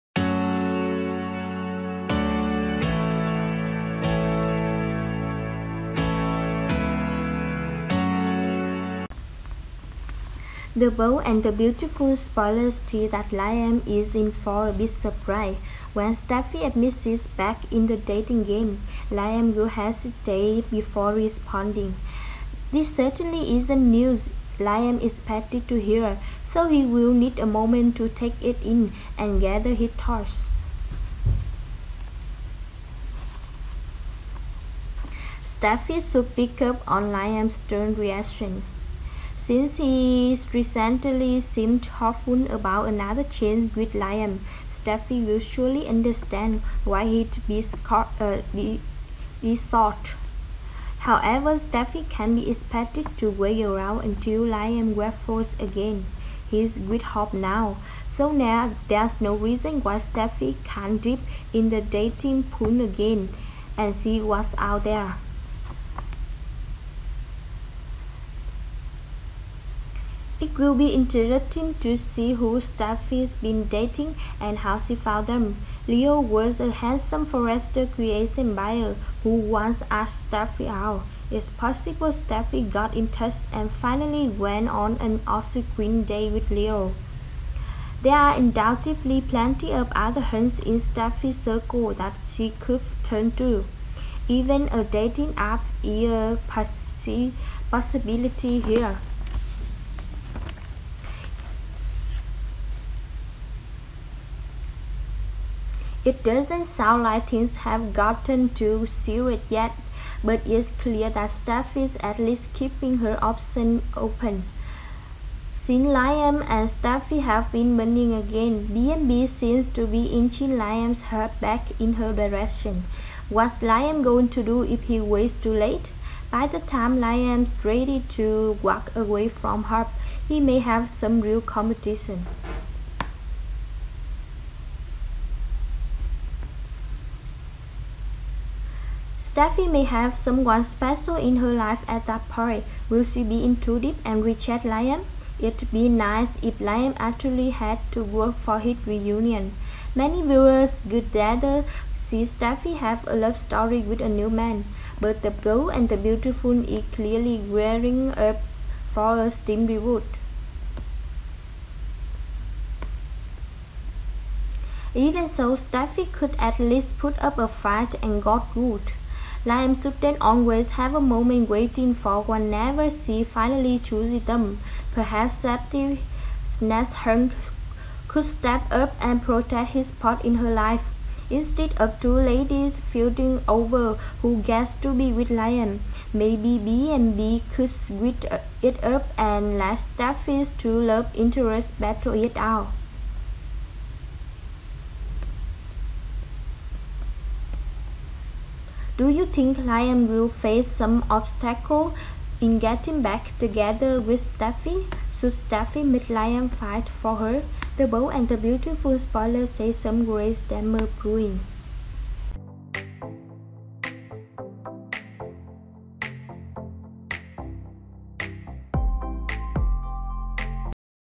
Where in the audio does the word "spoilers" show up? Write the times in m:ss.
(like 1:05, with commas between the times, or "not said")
0:12, 3:28.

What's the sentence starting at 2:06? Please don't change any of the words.
By the time Liam's ready to walk away from her, he may have some real competition.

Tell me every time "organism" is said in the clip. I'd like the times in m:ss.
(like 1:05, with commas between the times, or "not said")
not said.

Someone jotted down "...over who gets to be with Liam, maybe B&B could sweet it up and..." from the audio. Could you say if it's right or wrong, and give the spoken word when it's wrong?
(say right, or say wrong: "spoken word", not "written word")
right.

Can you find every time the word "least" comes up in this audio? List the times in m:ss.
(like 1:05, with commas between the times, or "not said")
1:52, 2:46.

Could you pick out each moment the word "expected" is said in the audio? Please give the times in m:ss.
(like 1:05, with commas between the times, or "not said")
0:25, 0:52.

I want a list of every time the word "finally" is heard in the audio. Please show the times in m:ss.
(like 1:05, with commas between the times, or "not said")
1:23, 2:53.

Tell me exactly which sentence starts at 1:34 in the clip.
Even a dating app is a possibility here.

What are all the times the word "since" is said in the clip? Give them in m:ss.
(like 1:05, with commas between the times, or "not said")
0:39, 1:55.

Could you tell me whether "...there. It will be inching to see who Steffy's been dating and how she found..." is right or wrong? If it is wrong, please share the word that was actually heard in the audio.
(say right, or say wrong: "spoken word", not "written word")
wrong: "interesting", not "inching".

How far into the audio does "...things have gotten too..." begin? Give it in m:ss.
1:47.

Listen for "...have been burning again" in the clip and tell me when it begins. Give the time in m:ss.
1:57.